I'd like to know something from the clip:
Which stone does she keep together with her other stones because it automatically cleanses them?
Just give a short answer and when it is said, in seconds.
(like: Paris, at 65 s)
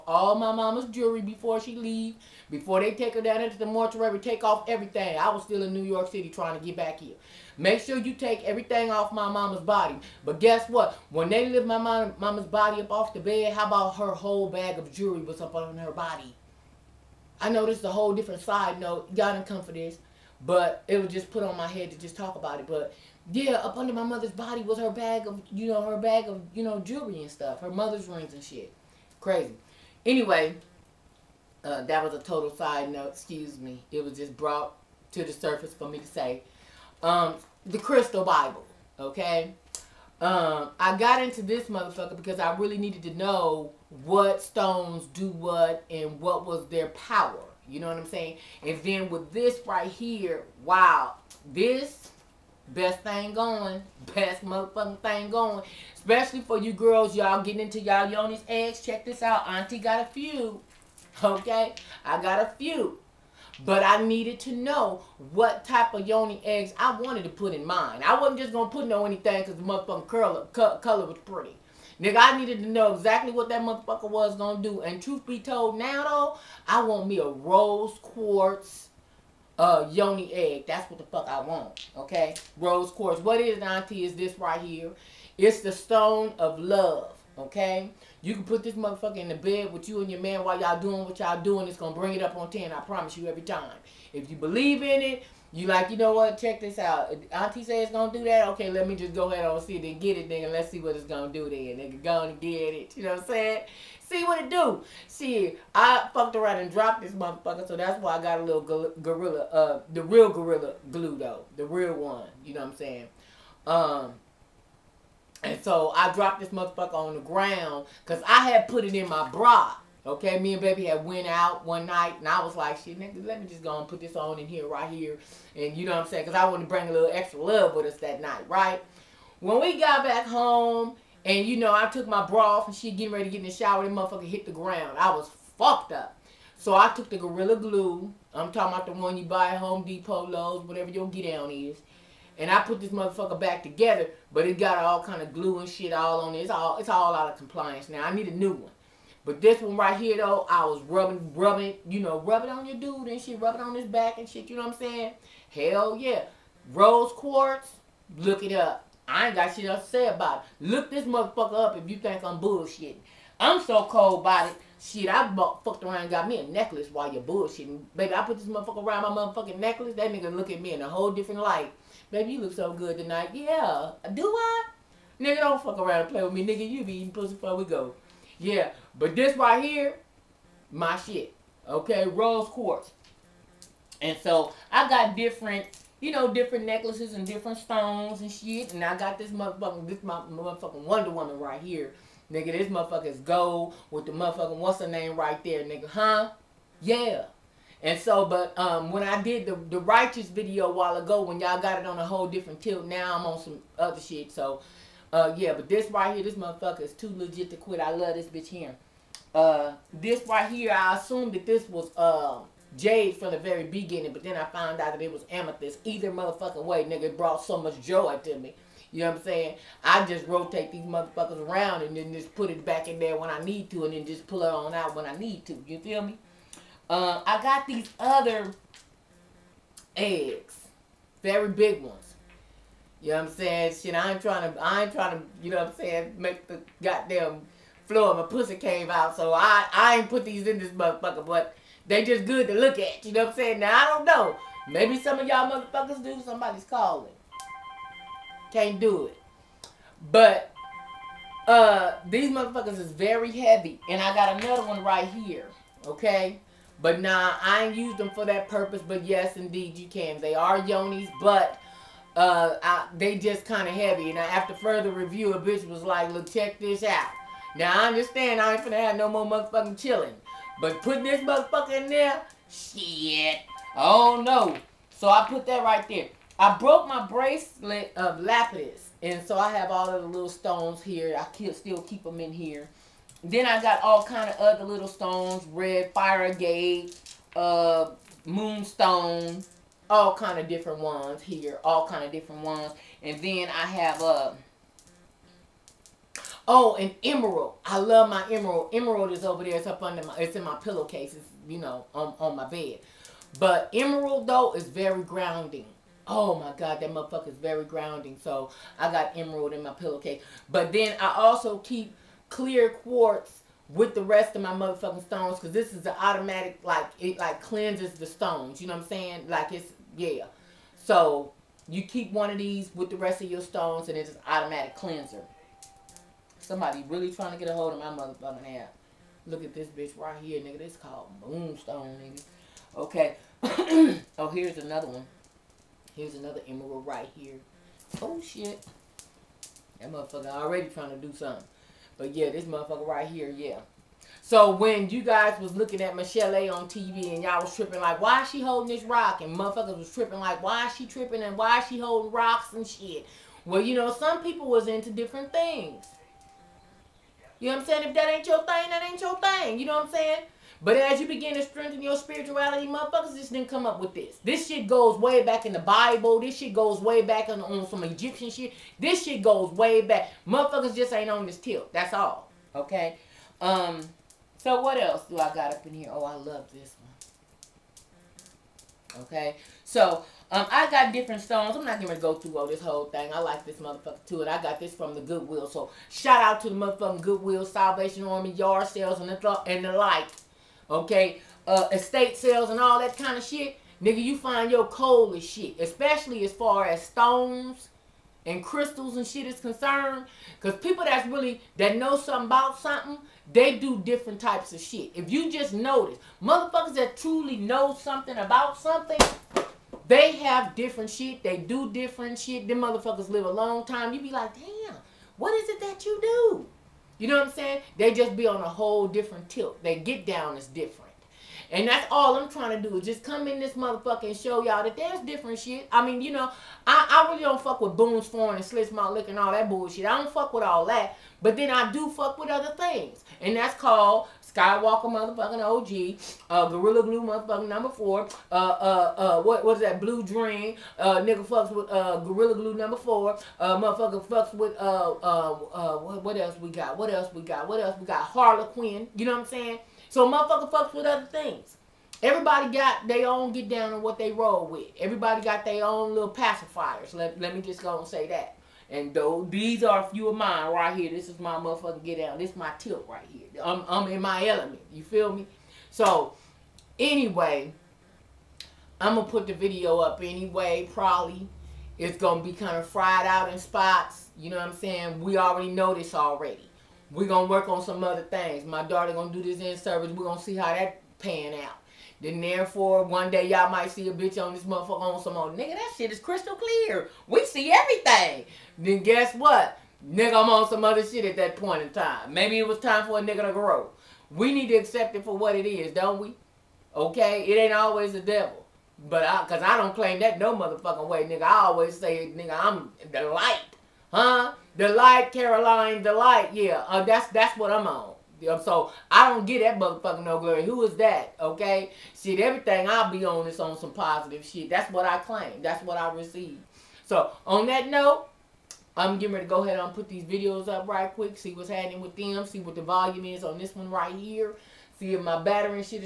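Clear quartz, at 312 s.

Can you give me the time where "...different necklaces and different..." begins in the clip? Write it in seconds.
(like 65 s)
186 s.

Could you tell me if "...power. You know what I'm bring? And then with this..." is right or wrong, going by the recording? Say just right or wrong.
wrong.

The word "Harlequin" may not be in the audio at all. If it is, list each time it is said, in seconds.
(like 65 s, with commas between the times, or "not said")
448 s.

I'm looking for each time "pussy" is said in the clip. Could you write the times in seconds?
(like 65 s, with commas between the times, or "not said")
177 s, 238 s.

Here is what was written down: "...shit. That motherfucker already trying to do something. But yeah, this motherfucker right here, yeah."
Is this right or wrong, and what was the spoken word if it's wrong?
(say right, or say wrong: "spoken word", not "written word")
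right.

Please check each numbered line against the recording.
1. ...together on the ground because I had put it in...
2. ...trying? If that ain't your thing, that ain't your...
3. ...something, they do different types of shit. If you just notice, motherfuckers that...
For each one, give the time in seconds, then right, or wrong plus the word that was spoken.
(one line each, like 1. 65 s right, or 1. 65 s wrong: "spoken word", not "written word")
1. 116 s wrong: "motherfucker", not "together"
2. 357 s wrong: "saying", not "trying"
3. 402 s right.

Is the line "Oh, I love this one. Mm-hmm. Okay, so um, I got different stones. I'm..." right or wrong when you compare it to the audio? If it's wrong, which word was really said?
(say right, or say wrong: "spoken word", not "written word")
right.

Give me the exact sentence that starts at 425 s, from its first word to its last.
I mean, you know, I, I really don't fuck with Boone's Farm and Slits My Lick and all that bullshit.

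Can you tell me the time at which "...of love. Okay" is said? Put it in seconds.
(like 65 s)
86 s.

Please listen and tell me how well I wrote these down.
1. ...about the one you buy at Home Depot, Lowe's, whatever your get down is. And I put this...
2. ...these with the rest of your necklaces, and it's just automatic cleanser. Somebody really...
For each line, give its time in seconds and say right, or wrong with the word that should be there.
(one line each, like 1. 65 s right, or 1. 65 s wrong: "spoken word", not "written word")
1. 138 s right
2. 322 s wrong: "stones", not "necklaces".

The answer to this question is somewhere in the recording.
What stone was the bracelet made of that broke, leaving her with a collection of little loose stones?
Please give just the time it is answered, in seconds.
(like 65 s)
278 s.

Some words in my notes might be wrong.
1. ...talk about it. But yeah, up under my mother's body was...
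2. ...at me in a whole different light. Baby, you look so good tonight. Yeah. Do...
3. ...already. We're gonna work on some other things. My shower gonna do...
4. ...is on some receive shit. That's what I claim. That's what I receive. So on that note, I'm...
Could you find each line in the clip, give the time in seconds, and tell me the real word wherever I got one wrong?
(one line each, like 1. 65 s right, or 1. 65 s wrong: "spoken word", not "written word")
1. 22 s right
2. 170 s right
3. 475 s wrong: "daughter", not "shower"
4. 513 s wrong: "positive", not "receive".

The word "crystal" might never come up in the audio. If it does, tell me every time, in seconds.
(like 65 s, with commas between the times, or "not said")
37 s, 398 s, 485 s.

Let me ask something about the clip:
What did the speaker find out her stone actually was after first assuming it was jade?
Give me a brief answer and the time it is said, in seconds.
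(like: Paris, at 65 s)
Amethyst, at 215 s.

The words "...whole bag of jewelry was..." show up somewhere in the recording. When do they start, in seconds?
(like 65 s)
14 s.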